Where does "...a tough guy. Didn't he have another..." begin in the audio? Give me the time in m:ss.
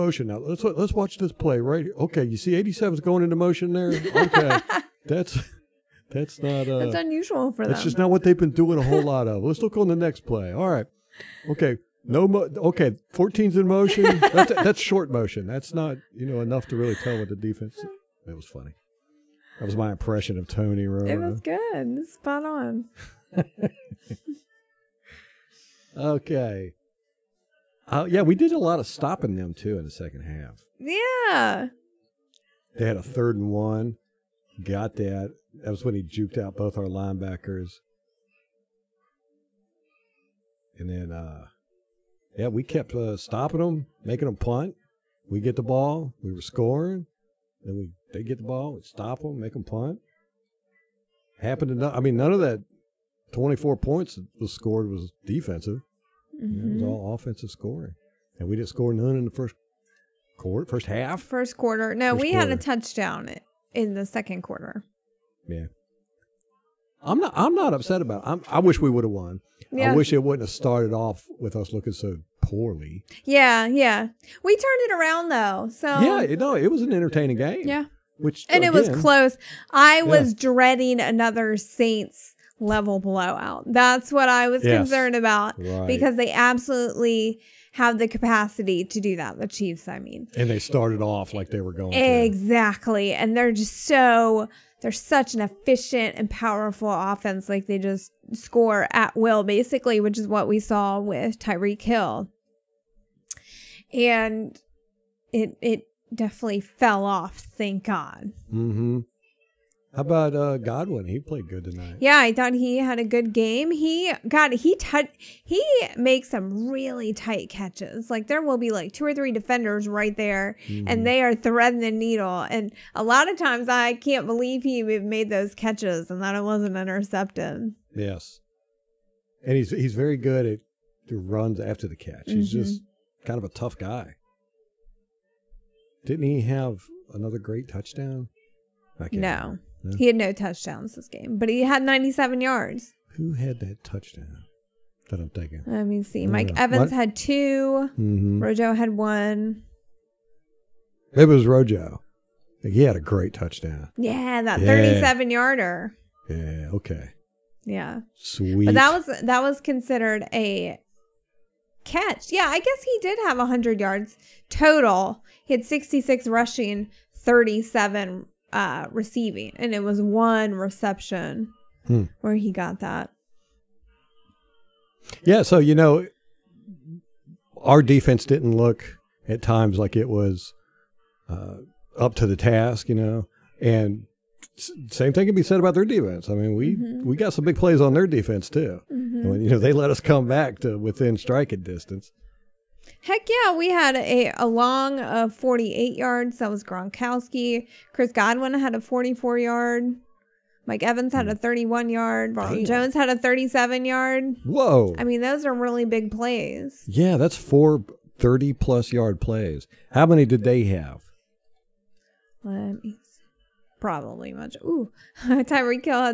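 2:13.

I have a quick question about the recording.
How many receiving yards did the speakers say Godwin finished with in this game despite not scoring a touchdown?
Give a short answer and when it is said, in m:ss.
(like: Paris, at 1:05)
97, at 2:21.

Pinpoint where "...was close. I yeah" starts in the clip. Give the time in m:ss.
1:18.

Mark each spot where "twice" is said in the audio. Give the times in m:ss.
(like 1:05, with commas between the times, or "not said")
not said.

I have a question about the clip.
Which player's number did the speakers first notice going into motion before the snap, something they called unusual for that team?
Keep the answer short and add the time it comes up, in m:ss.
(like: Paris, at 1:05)
87, at 0:02.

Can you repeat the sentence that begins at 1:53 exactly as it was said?
He got he t- he makes some really tight catches.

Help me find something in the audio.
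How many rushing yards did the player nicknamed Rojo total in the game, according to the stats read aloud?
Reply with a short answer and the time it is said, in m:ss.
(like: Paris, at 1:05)
66, at 2:45.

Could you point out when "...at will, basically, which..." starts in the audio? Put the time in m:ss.
1:38.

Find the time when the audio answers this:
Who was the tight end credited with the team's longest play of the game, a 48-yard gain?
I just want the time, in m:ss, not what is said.
3:16.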